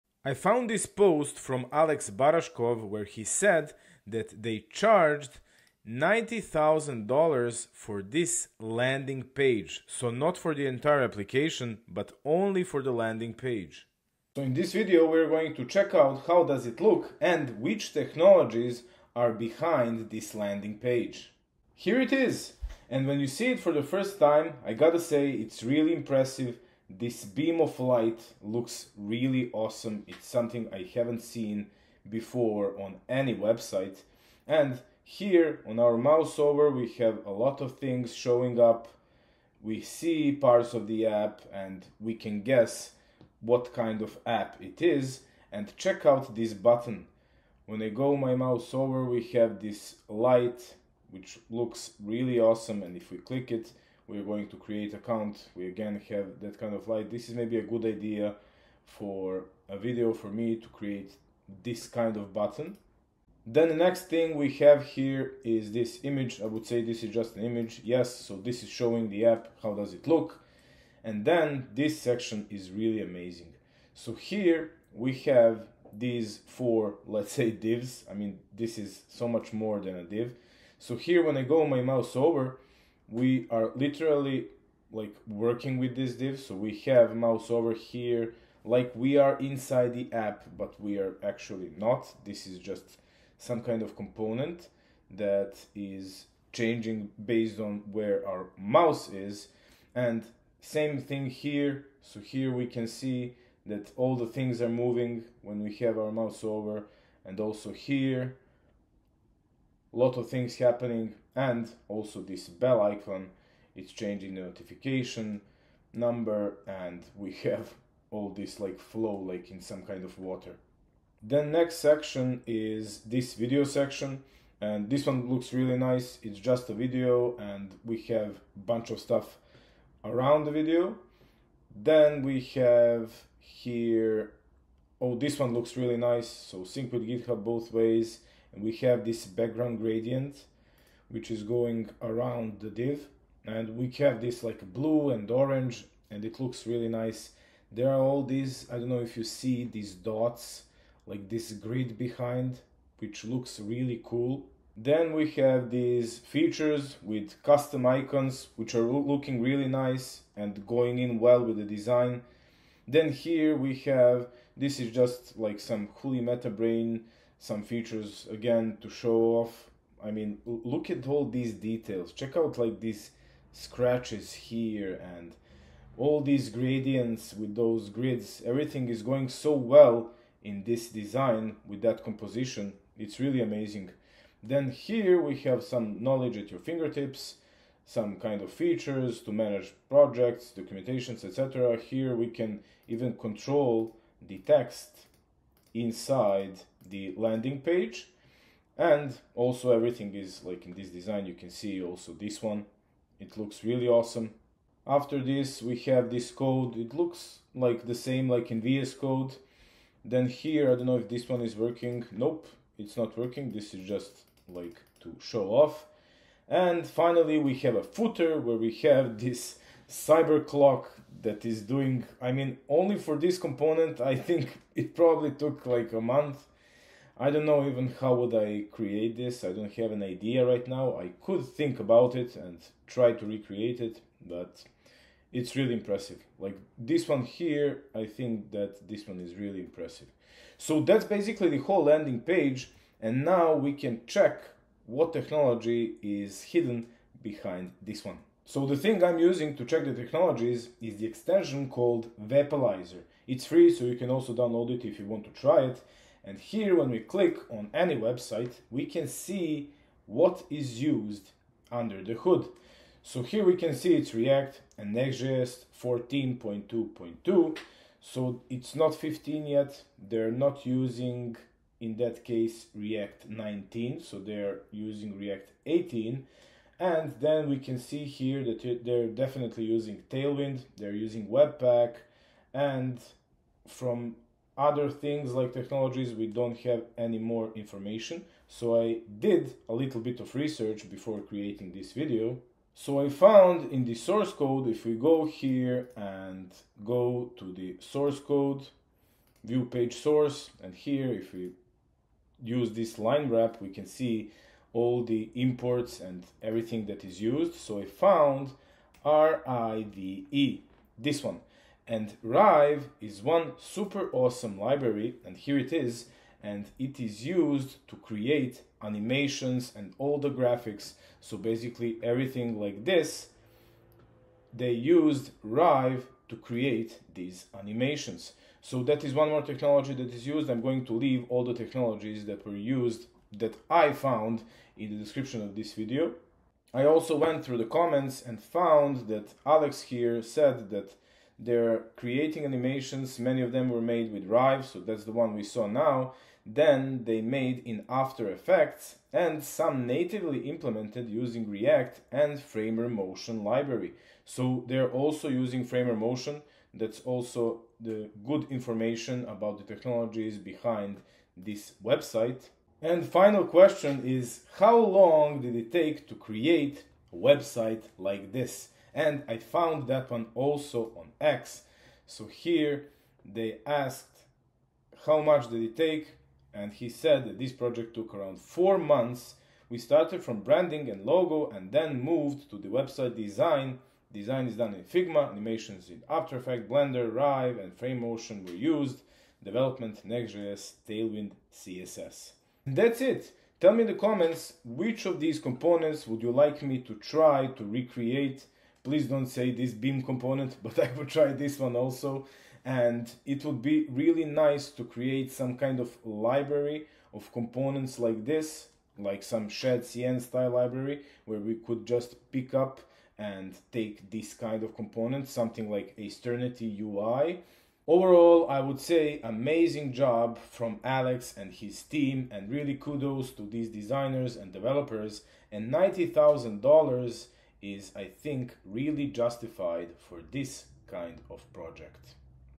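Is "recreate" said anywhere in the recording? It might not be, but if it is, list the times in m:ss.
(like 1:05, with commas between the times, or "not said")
3:53, 6:37.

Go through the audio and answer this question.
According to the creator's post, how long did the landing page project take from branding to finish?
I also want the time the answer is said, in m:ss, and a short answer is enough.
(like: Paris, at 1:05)
4 months, at 6:18.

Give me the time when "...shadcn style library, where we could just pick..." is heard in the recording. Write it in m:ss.
6:49.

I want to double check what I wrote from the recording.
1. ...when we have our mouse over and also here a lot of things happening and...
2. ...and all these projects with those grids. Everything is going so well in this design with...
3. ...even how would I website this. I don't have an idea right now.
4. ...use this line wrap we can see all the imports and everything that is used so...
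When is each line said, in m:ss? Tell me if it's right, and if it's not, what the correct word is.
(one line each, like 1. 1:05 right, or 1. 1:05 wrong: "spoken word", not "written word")
1. 1:45 right
2. 2:55 wrong: "gradients", not "projects"
3. 3:47 wrong: "create", not "website"
4. 5:02 right.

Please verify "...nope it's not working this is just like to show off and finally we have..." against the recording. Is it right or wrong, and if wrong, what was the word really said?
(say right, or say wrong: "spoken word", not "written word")
right.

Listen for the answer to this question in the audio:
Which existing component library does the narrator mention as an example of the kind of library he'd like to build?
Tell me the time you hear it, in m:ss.
6:55.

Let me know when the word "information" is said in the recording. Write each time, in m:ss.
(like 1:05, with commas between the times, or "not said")
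4:47, 5:58.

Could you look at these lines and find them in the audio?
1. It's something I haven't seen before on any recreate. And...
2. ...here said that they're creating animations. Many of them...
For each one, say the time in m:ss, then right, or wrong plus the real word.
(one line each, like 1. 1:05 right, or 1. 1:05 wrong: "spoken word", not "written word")
1. 0:30 wrong: "website", not "recreate"
2. 5:39 right.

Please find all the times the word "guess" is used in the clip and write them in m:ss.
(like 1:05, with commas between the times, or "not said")
0:42.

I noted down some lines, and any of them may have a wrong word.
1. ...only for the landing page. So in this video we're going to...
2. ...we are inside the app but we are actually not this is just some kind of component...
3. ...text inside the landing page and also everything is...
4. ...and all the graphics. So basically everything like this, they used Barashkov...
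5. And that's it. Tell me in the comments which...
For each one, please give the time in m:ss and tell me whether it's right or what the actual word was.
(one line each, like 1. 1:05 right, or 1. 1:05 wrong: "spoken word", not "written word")
1. 0:12 right
2. 1:28 right
3. 3:14 right
4. 5:19 wrong: "Rive", not "Barashkov"
5. 6:32 right.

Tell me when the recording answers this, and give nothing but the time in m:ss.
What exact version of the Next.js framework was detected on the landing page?
4:25.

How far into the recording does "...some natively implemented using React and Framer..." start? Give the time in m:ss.
5:49.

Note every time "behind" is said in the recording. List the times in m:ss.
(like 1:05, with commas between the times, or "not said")
0:19, 2:31, 4:07, 6:00.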